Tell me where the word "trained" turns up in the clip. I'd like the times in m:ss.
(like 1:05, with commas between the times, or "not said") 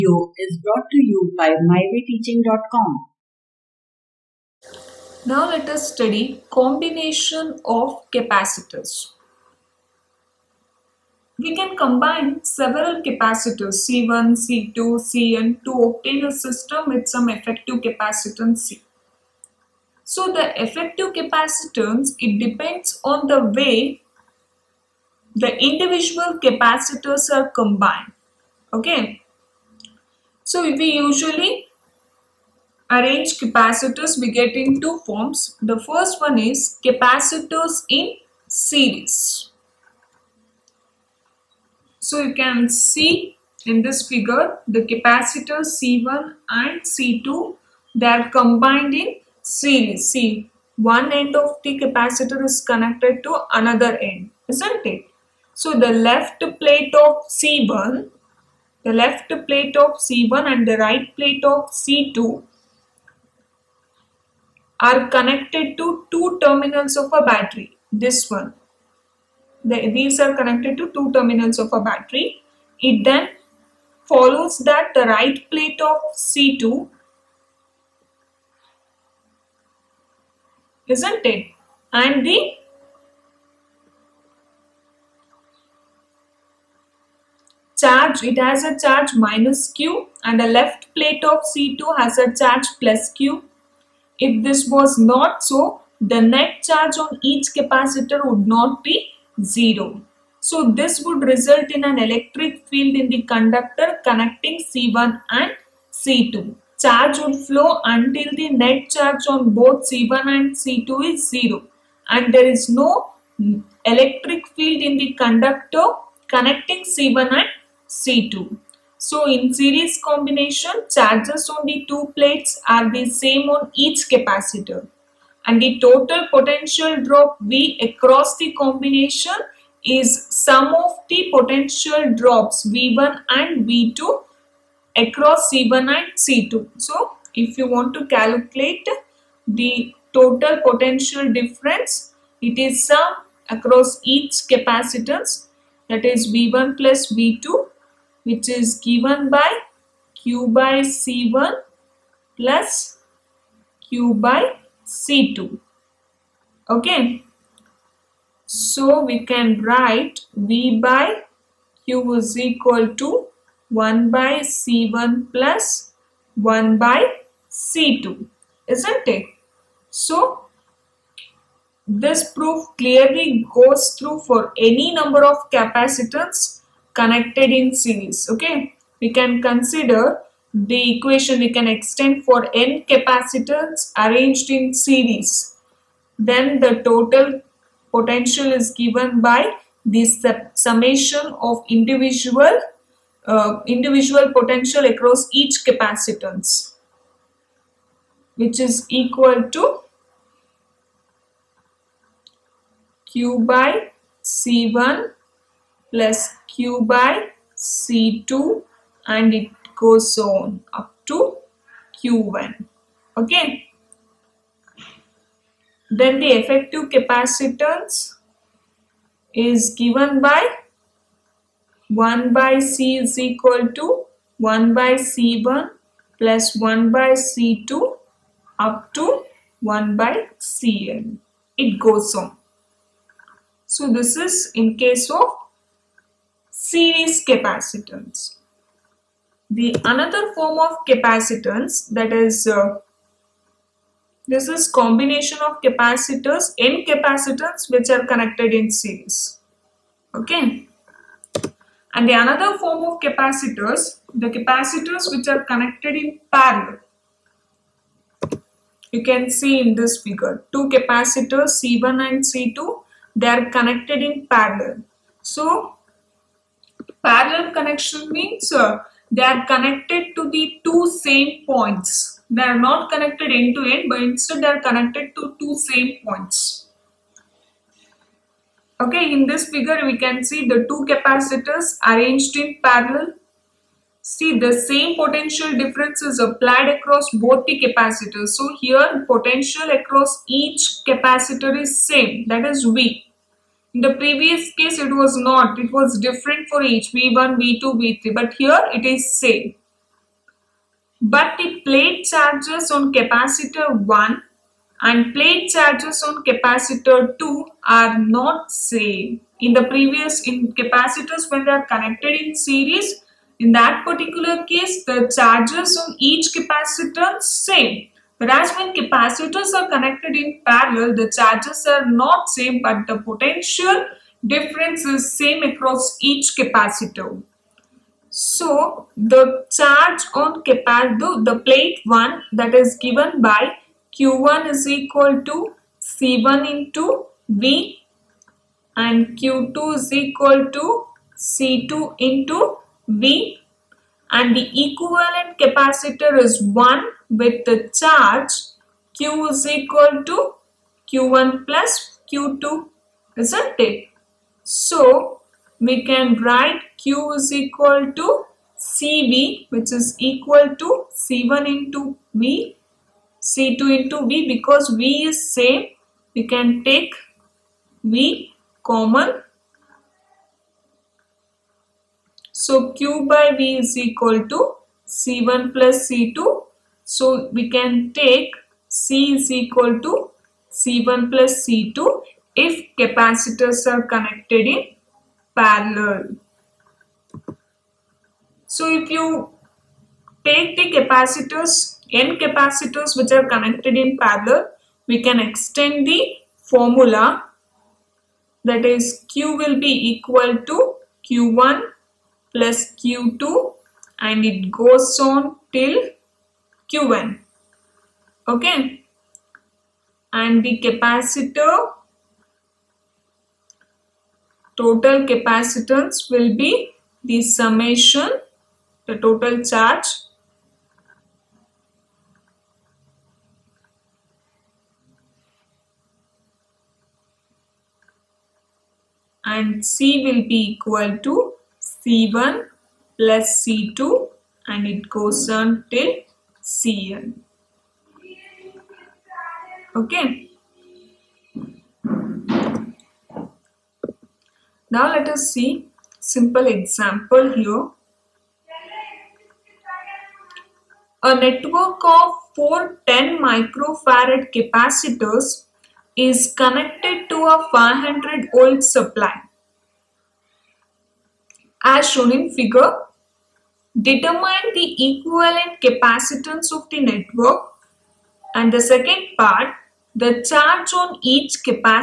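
not said.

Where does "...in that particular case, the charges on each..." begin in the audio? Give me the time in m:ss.
5:13.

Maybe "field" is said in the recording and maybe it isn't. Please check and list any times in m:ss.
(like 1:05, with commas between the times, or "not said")
1:42, 1:54.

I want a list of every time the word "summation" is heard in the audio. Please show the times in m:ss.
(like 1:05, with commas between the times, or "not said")
3:10, 6:57.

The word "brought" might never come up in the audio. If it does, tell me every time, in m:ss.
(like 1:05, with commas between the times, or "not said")
0:00.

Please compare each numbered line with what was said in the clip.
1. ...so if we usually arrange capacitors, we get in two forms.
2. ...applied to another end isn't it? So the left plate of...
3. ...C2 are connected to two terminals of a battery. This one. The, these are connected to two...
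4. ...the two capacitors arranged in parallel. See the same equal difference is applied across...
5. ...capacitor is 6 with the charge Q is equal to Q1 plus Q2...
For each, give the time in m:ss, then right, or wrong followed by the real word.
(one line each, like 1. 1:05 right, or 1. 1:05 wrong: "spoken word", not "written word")
1. 0:30 right
2. 0:52 wrong: "connected", not "applied"
3. 1:01 right
4. 4:40 wrong: "potential", not "equal"
5. 5:45 wrong: "1", not "6".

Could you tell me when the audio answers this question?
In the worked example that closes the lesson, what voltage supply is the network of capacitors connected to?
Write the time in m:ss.
7:37.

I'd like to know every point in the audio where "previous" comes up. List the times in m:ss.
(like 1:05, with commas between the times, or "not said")
4:53, 5:09.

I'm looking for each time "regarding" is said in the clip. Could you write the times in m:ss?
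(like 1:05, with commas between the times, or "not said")
not said.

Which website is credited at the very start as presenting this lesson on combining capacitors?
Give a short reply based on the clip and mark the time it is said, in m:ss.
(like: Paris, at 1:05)
mywayteaching.com, at 0:01.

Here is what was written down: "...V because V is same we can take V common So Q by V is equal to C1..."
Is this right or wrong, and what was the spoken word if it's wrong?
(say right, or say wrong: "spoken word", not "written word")
right.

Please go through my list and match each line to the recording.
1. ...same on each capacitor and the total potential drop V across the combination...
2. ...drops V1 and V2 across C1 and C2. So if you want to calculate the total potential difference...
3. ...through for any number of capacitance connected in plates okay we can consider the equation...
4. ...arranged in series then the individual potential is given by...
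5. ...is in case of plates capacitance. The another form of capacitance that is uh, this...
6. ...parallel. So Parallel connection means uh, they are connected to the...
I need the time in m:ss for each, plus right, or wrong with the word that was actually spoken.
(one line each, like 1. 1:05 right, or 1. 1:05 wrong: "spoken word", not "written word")
1. 2:03 right
2. 2:12 right
3. 2:53 wrong: "series", not "plates"
4. 3:04 wrong: "total", not "individual"
5. 3:54 wrong: "series", not "plates"
6. 4:24 right.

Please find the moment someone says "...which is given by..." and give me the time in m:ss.
2:28.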